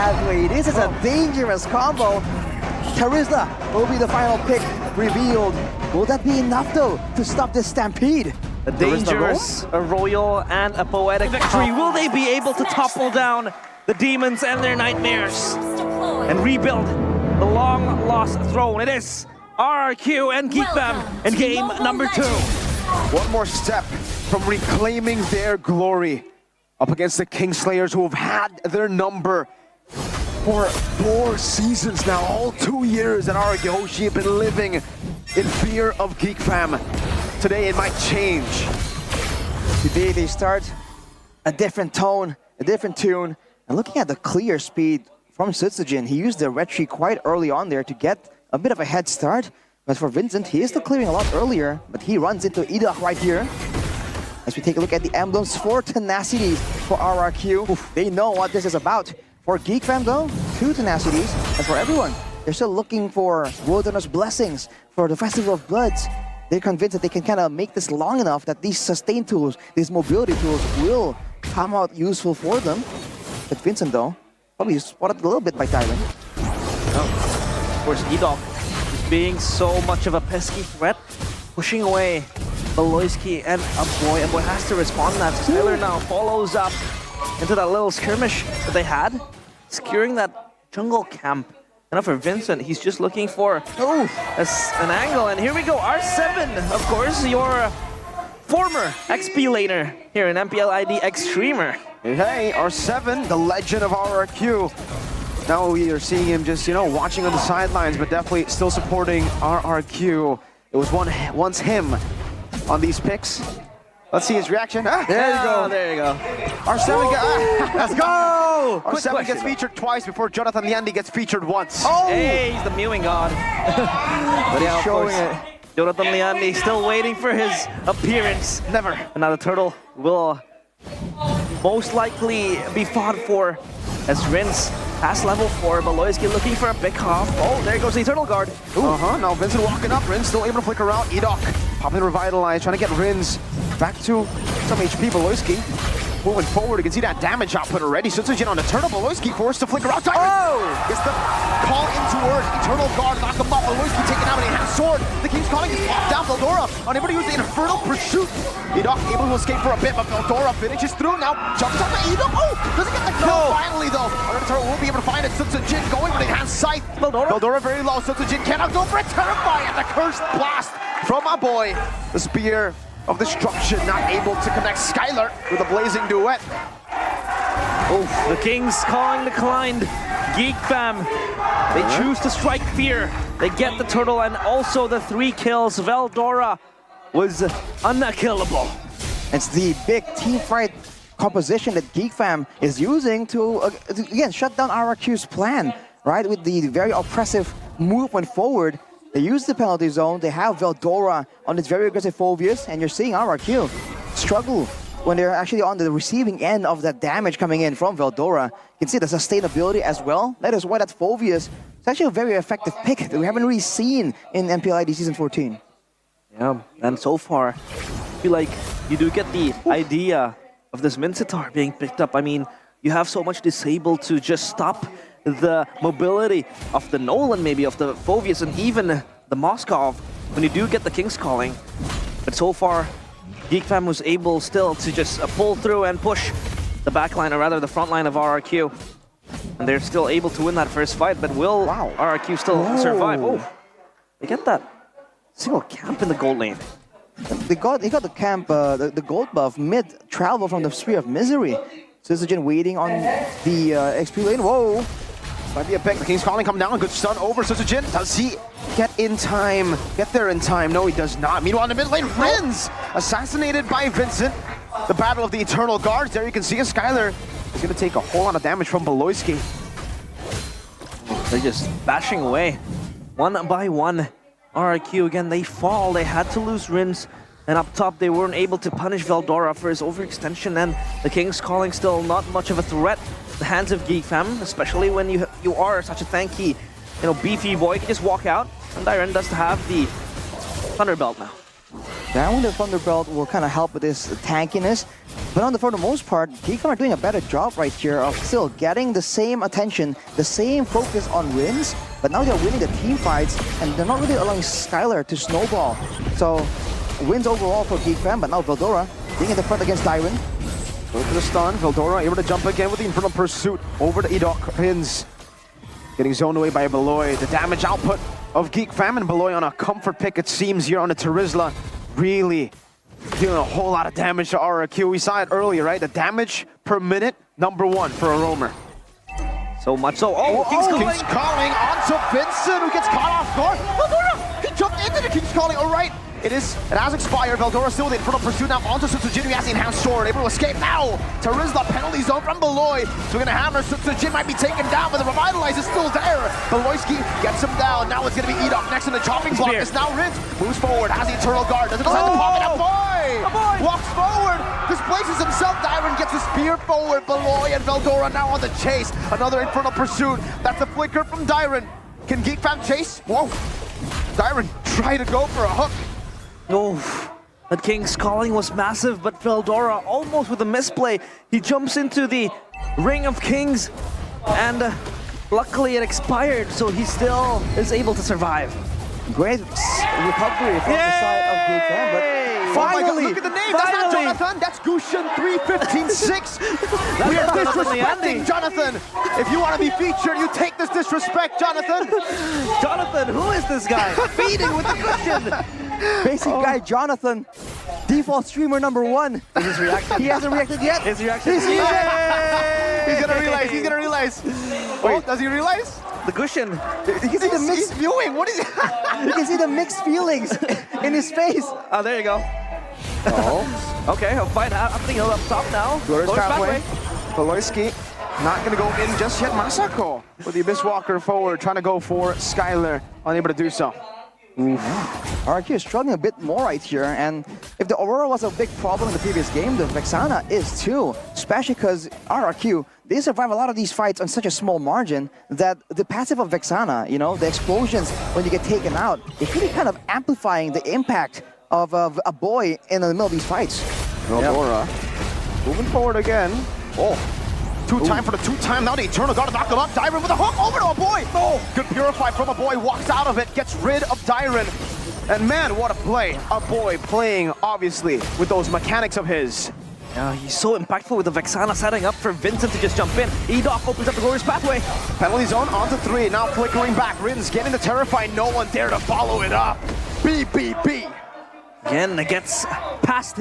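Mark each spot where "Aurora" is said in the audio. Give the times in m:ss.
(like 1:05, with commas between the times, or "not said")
7:07, 7:24.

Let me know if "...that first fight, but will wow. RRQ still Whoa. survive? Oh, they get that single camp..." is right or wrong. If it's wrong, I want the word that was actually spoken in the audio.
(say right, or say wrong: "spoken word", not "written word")
right.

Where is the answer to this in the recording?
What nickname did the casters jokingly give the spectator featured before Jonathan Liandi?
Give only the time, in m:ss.
2:02.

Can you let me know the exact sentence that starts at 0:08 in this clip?
A dangerous, a royal, and a poetic victory.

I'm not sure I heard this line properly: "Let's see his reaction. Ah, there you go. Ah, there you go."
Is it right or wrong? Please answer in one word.
right.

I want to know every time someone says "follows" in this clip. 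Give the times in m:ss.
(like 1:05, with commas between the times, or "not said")
1:26, 7:48.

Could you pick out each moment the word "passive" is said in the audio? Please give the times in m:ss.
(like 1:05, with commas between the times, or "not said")
7:15.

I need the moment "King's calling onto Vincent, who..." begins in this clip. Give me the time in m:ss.
5:30.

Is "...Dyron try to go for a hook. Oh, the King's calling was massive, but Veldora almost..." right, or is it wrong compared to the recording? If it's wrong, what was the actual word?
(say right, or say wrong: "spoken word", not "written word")
right.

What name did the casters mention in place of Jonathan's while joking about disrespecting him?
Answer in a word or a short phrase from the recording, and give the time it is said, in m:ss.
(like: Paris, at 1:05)
Gushin 3156, at 6:24.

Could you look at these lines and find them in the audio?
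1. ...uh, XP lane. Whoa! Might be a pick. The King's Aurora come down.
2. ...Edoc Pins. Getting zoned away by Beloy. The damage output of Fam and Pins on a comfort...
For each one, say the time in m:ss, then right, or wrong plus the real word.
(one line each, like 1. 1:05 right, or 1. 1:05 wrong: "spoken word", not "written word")
1. 4:13 wrong: "Calling", not "Aurora"
2. 5:14 wrong: "Beloy", not "Pins".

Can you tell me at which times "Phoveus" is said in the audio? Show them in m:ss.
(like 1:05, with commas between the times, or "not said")
3:22, 3:30, 3:47.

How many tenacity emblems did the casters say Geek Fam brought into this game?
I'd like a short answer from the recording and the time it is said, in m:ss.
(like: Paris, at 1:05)
2, at 1:00.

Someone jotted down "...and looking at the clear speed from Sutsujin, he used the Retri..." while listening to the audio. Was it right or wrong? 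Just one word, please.
right.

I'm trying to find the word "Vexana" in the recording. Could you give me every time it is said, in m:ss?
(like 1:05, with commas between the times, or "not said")
7:09, 7:16, 7:41.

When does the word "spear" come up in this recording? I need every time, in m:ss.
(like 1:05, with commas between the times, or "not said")
2:52, 4:10, 5:56.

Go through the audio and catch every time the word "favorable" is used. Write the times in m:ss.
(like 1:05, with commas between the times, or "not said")
not said.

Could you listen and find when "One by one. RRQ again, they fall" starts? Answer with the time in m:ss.
4:33.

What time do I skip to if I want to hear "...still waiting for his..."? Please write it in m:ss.
2:06.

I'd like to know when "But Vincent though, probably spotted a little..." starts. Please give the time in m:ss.
1:13.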